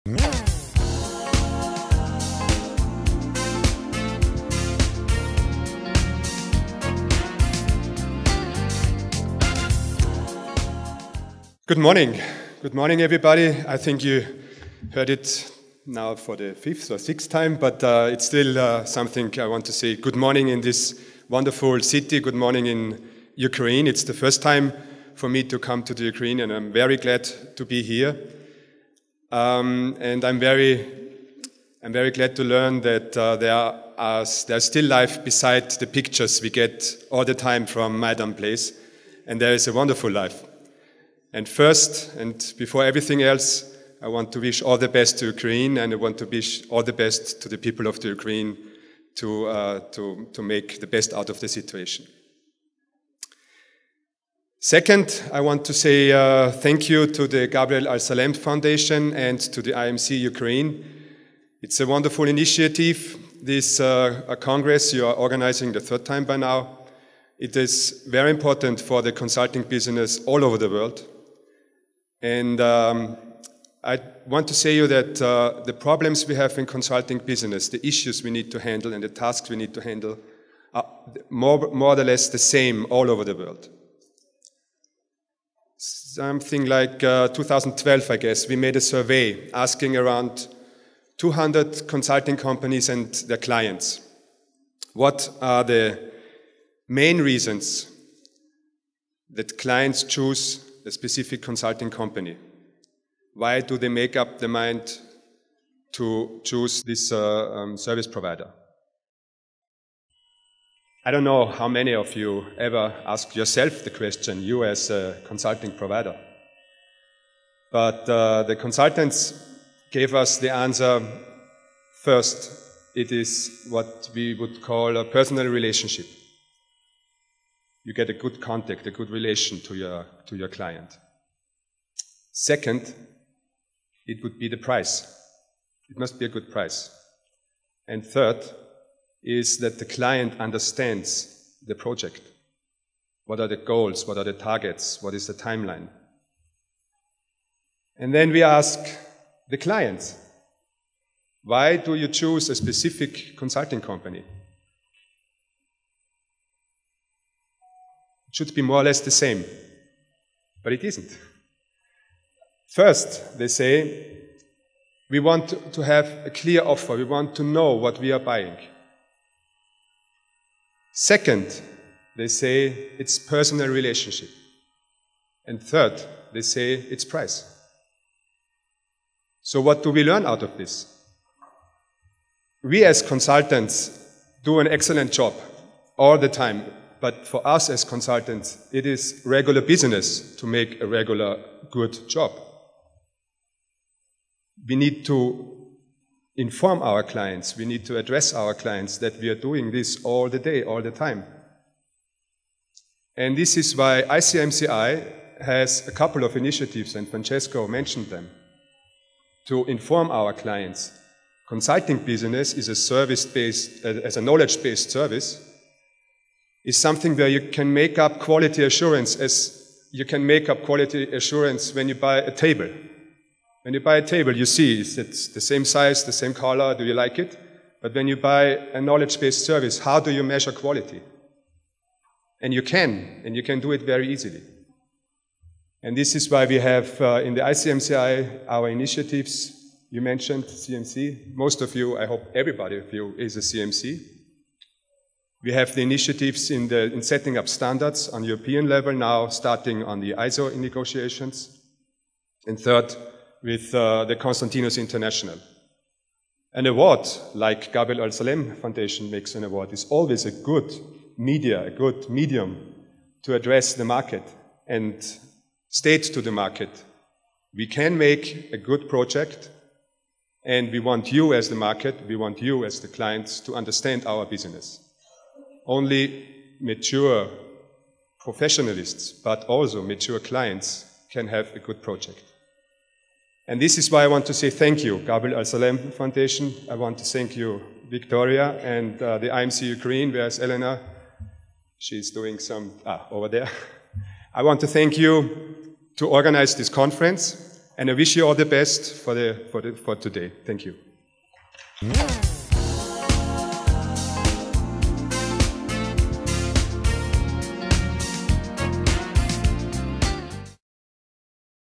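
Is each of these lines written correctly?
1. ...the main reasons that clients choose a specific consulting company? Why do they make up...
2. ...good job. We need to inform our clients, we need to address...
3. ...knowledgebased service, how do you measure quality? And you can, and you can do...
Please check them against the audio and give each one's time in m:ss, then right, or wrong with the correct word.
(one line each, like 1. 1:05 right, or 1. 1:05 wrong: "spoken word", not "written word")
1. 1:35 right
2. 3:11 right
3. 3:49 wrong: "based", not "knowledgebased".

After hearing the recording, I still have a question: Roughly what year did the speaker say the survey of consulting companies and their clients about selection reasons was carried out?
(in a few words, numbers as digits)
2012.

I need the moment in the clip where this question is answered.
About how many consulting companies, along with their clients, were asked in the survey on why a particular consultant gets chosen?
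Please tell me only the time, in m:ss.
1:31.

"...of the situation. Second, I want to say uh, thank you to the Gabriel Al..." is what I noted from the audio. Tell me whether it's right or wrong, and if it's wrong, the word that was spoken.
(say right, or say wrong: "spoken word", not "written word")
right.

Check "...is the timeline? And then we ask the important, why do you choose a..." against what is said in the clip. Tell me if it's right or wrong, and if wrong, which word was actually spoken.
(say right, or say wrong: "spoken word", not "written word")
wrong: "client", not "important".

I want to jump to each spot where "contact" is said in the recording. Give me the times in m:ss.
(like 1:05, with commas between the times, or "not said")
2:08.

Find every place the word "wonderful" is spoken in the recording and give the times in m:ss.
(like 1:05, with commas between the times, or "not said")
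0:21, 0:39, 1:01.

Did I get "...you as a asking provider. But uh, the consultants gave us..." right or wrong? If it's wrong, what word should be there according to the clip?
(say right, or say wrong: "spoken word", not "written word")
wrong: "consulting", not "asking".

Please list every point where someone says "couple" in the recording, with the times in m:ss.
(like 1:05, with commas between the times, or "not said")
3:25.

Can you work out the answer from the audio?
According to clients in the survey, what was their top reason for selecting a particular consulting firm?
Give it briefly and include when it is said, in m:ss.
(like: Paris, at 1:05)
A clear offer, at 2:46.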